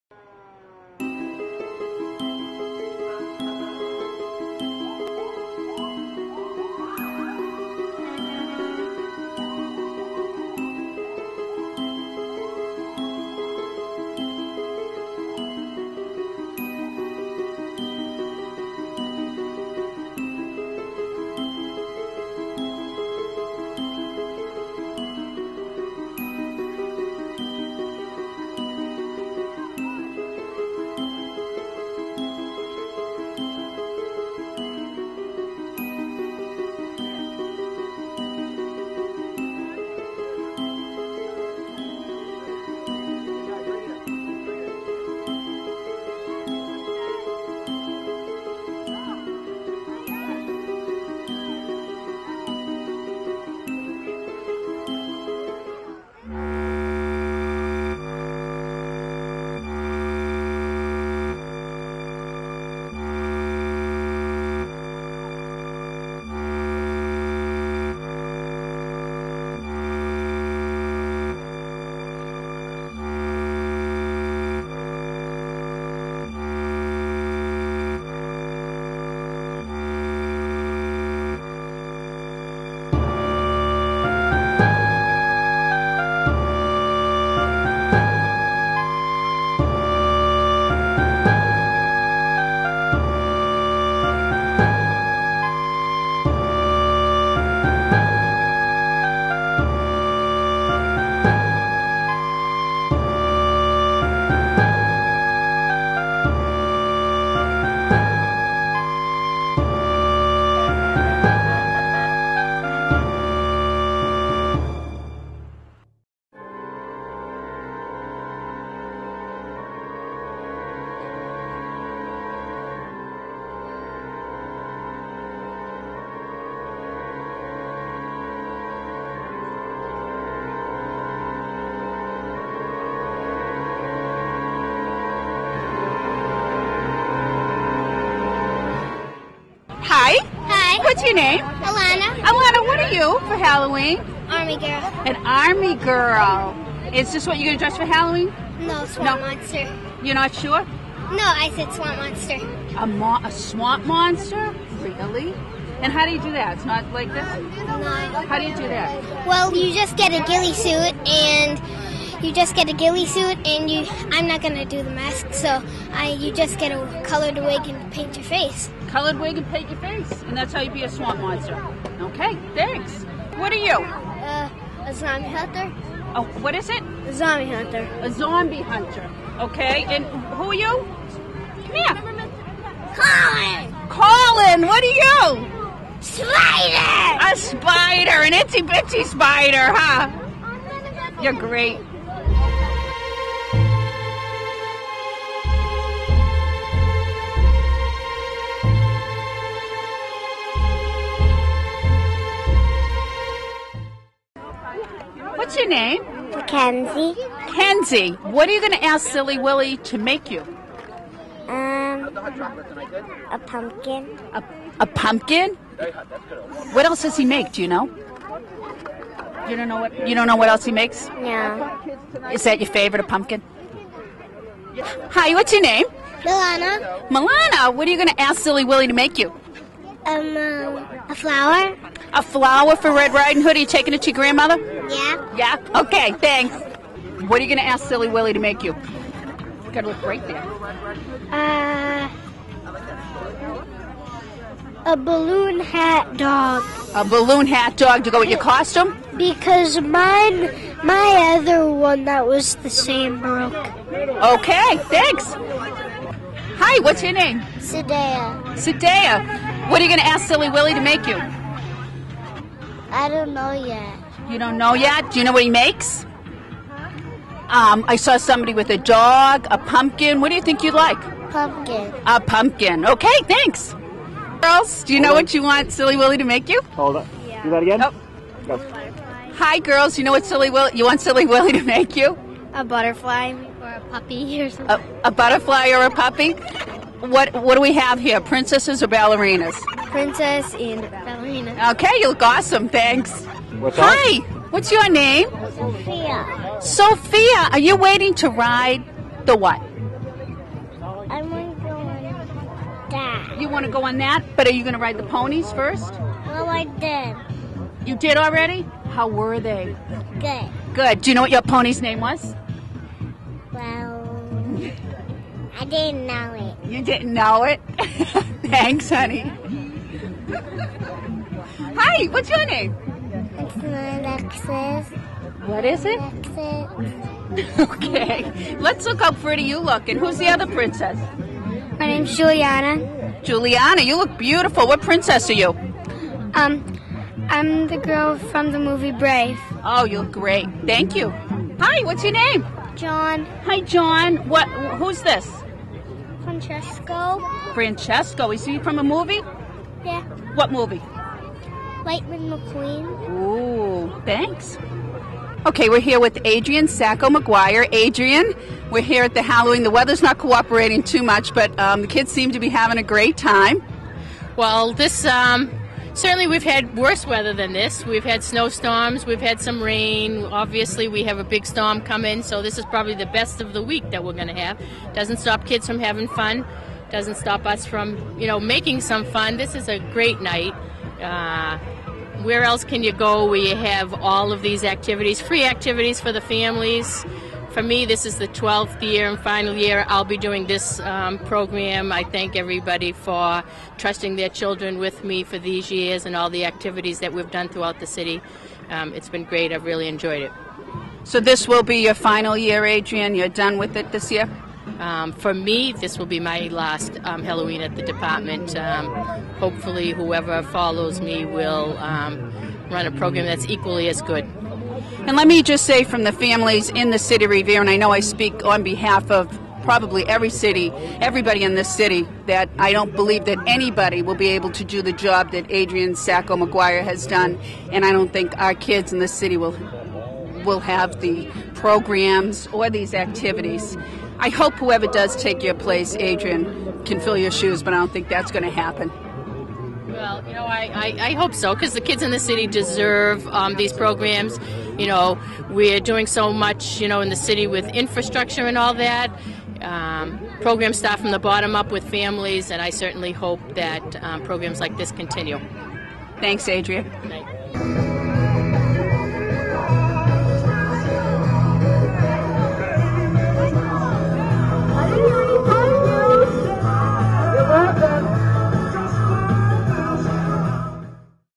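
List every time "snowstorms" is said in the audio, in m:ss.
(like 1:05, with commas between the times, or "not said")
6:08.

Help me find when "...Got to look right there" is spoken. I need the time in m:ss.
3:59.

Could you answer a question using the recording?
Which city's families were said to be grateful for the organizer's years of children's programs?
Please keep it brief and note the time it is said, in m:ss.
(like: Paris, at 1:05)
Revere, at 6:57.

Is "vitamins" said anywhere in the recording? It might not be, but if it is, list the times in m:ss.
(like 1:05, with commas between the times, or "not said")
not said.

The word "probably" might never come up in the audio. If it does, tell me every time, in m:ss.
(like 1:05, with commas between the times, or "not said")
6:12, 6:59.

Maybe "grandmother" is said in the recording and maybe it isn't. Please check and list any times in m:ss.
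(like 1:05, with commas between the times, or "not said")
3:54.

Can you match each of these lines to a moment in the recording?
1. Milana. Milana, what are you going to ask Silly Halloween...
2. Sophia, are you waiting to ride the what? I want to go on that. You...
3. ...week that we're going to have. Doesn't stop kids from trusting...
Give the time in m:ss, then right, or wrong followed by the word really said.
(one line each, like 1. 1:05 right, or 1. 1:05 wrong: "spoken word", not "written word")
1. 3:46 wrong: "Willy", not "Halloween"
2. 4:56 right
3. 6:13 wrong: "having", not "trusting".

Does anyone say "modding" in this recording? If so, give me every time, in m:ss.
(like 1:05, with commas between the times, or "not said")
not said.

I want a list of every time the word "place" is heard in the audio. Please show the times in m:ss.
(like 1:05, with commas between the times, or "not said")
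7:15.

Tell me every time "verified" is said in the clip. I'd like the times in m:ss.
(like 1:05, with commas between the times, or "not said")
not said.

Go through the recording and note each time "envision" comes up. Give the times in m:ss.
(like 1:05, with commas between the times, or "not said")
not said.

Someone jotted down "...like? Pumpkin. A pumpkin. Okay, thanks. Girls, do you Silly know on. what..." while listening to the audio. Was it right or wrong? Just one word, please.
wrong.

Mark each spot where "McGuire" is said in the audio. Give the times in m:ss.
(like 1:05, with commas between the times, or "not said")
5:57, 7:06.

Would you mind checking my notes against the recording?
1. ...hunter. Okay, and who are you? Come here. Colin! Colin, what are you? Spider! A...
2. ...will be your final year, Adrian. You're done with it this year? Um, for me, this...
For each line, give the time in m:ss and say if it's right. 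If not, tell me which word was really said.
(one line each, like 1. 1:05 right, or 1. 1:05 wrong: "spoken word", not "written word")
1. 2:58 right
2. 6:41 right.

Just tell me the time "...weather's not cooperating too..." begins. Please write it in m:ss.
5:59.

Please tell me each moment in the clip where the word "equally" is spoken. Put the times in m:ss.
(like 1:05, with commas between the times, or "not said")
6:53.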